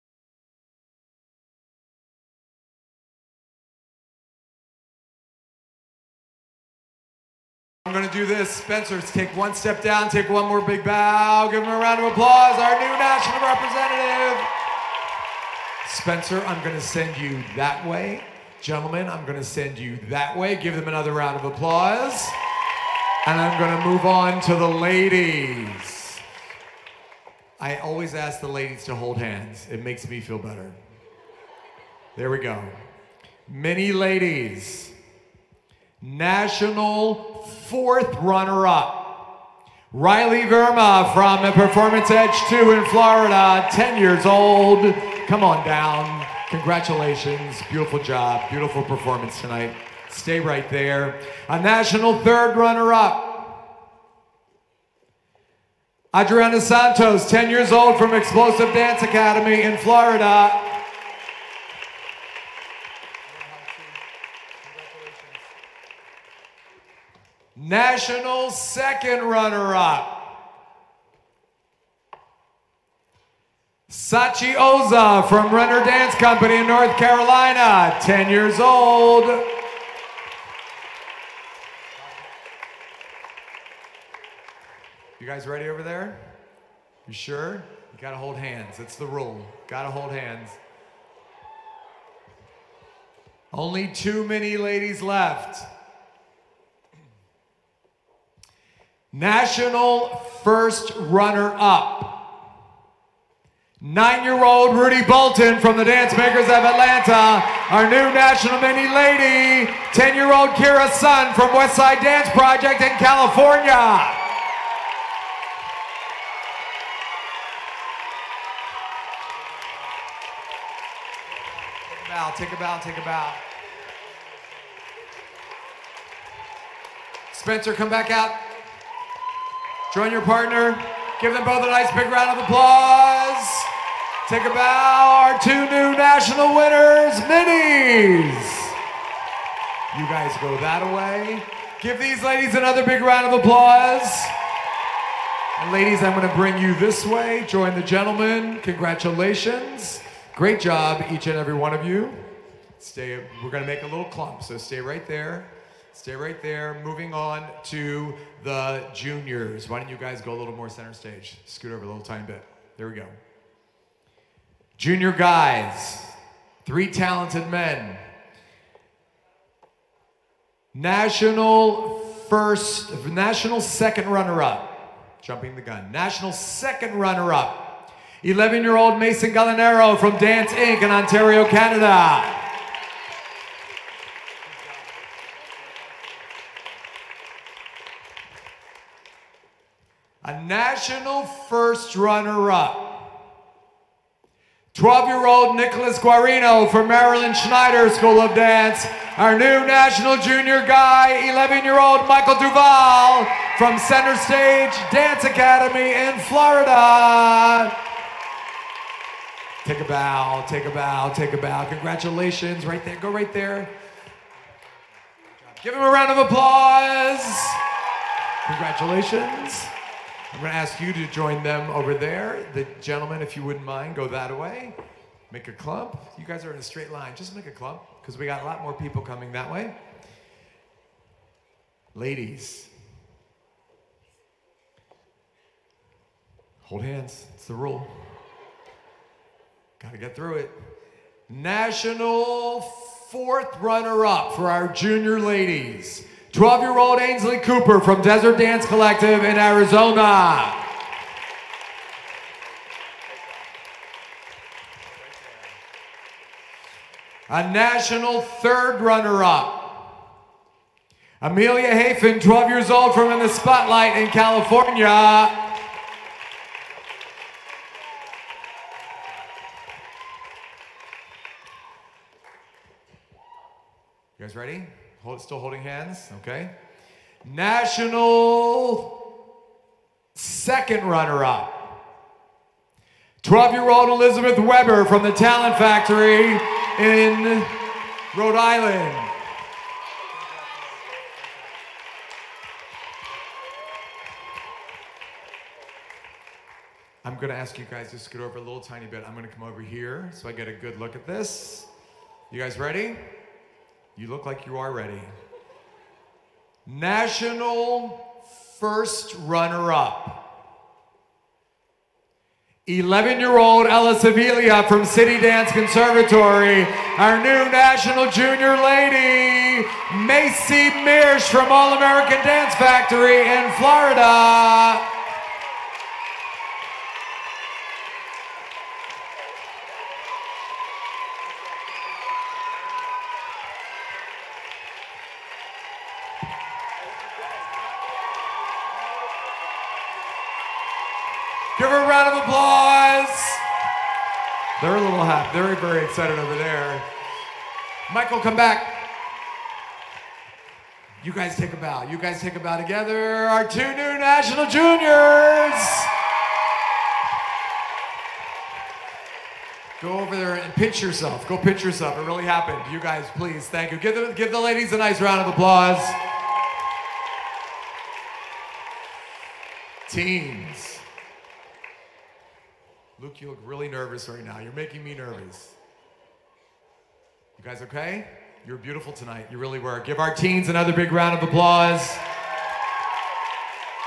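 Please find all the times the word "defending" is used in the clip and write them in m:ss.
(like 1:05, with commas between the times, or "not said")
not said.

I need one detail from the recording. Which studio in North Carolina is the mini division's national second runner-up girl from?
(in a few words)
Renner Dance Company.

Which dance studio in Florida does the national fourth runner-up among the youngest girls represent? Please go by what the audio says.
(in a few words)
Performance Edge 2.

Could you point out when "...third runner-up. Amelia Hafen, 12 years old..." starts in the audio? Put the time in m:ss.
4:18.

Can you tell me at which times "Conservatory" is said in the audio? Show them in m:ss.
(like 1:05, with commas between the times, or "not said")
5:15.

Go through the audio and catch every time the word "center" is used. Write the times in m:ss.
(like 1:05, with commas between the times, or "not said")
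2:40, 3:23.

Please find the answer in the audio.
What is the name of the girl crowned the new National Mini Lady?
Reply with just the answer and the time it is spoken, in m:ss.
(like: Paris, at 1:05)
Kira Sun, at 1:50.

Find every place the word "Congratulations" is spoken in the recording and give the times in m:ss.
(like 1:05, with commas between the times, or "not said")
0:46, 2:28, 3:31, 3:38.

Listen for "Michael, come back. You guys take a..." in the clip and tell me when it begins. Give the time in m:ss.
5:47.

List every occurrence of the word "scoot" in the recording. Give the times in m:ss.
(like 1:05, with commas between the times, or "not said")
2:41, 4:57.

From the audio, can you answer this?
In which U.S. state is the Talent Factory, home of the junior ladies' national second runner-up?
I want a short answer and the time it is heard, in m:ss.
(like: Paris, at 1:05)
Rhode Island, at 4:48.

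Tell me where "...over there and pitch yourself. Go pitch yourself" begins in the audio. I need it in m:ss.
5:59.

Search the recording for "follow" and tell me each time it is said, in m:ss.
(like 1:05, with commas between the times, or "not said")
not said.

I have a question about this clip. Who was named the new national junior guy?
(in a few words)
Michael Duval.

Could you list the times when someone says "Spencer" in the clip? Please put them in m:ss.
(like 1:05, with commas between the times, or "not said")
0:08, 0:16, 2:07.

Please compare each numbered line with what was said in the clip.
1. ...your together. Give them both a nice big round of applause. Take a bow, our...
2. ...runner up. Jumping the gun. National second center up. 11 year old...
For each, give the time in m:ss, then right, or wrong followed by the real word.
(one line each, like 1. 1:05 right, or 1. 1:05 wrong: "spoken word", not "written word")
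1. 2:10 wrong: "partner", not "together"
2. 2:54 wrong: "runner", not "center".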